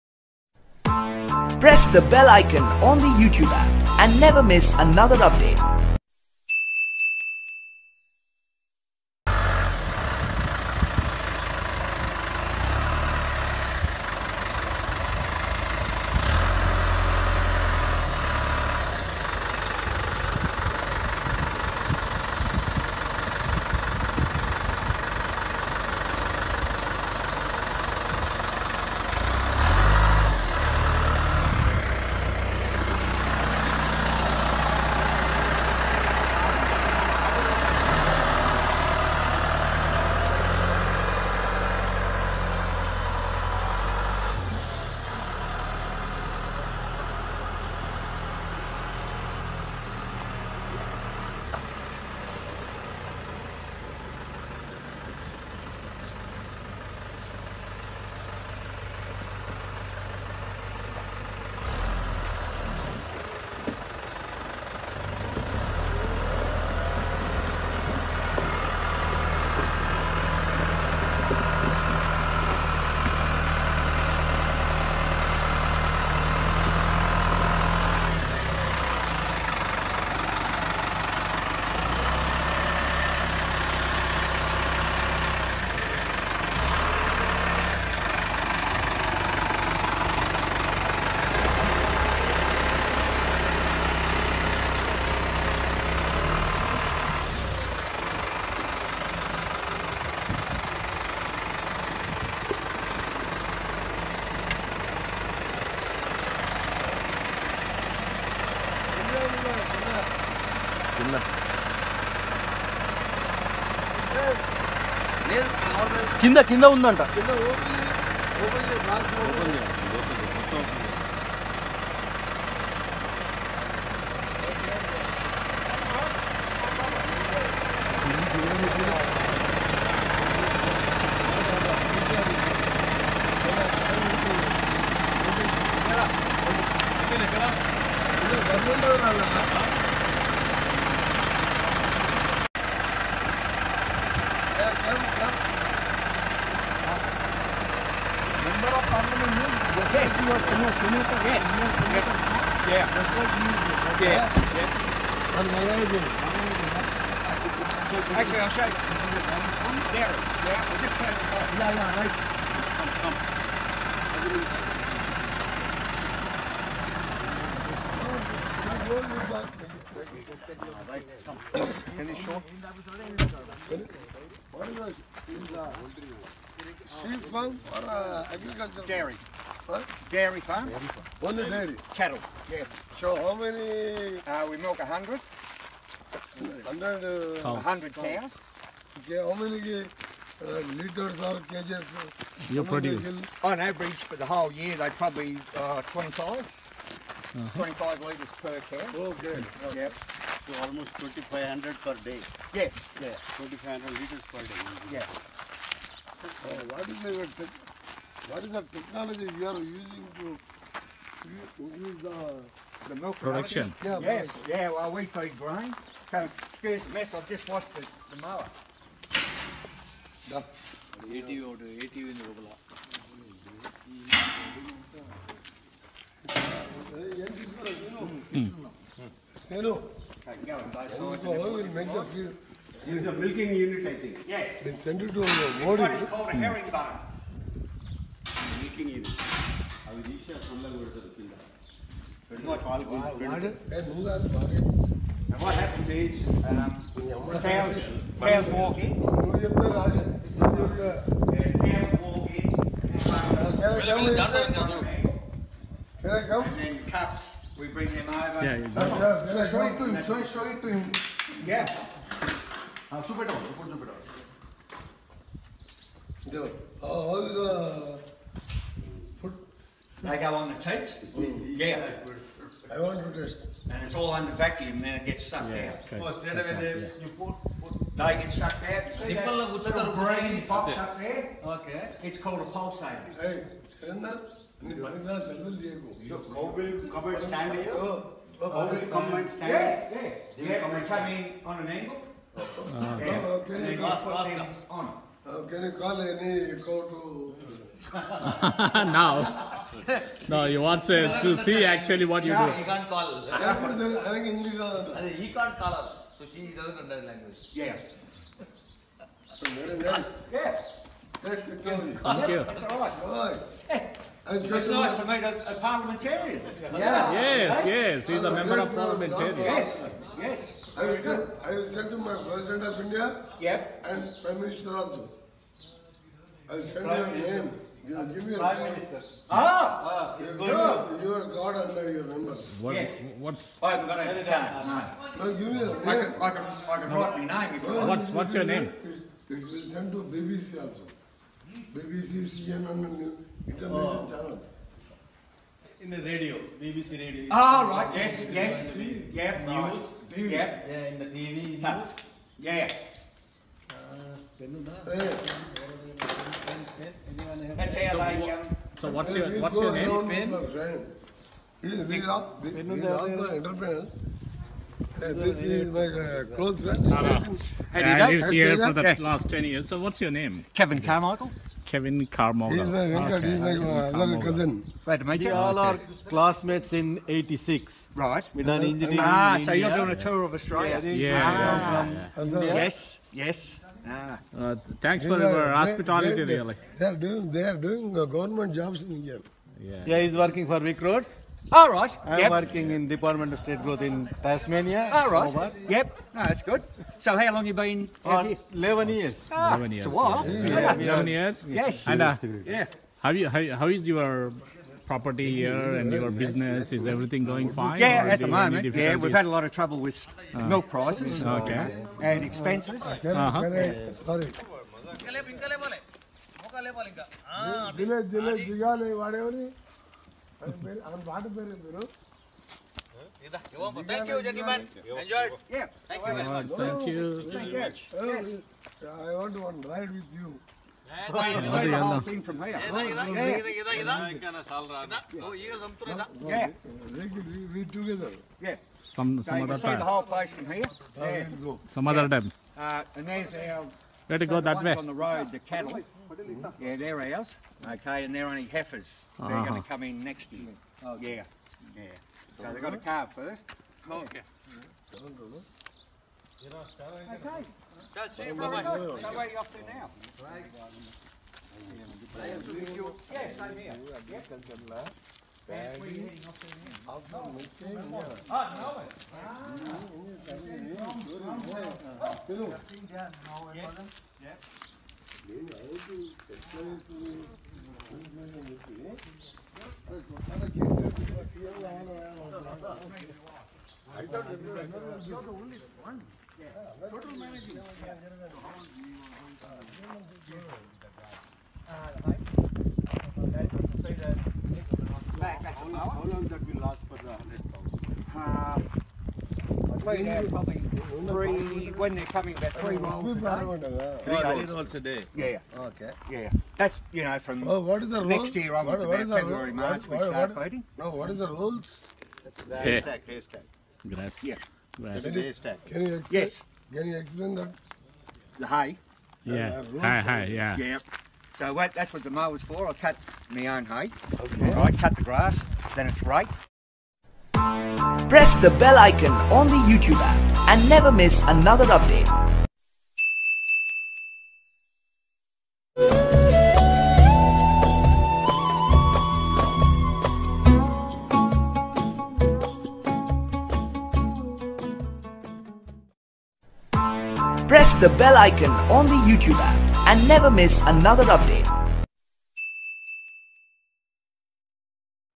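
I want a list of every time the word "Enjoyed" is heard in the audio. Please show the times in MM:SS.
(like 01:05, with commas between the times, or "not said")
07:05.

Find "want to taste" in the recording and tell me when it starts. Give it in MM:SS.
04:30.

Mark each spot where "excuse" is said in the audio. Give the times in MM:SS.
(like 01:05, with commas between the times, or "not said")
03:36.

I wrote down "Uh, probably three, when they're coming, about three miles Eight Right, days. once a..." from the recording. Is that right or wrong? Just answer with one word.
wrong.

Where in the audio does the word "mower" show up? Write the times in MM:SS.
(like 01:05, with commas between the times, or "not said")
03:38, 08:42.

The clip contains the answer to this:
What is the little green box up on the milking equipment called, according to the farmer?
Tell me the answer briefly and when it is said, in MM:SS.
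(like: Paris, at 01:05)
pulsator, at 04:42.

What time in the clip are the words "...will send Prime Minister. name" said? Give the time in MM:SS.
05:26.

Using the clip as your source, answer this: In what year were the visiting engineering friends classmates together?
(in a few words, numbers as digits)
86.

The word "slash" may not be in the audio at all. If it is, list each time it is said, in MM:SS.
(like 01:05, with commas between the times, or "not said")
not said.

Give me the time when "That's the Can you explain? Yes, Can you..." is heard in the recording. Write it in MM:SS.
08:35.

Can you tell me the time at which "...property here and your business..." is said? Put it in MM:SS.
06:44.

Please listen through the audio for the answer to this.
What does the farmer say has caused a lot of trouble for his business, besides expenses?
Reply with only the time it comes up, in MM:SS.
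06:50.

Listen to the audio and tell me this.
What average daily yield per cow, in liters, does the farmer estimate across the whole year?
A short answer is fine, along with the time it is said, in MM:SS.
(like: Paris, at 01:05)
25, at 03:17.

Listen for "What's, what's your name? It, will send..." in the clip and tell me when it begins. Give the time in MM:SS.
05:37.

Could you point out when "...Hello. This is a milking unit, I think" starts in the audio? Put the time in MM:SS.
03:49.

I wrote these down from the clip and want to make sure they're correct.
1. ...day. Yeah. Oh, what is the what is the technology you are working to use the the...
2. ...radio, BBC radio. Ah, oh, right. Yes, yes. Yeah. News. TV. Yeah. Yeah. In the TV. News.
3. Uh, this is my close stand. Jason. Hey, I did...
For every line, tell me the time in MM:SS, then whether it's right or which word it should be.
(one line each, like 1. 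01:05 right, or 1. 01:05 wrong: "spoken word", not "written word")
1. 03:24 wrong: "using", not "working"
2. 05:46 right
3. 06:04 wrong: "friend", not "stand".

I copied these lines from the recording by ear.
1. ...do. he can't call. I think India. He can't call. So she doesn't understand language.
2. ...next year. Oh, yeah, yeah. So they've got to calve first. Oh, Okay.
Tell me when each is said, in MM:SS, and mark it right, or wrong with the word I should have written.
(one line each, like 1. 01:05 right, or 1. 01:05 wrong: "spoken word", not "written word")
1. 05:02 wrong: "English", not "India"
2. 07:30 right.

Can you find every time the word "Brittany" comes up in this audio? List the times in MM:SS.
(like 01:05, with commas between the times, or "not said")
not said.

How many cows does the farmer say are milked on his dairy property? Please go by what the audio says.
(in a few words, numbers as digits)
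100.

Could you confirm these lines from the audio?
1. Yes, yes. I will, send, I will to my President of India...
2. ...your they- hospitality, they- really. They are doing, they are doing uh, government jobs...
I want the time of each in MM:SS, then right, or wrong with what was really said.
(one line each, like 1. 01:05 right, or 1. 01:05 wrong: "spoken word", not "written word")
1. 05:19 right
2. 06:25 right.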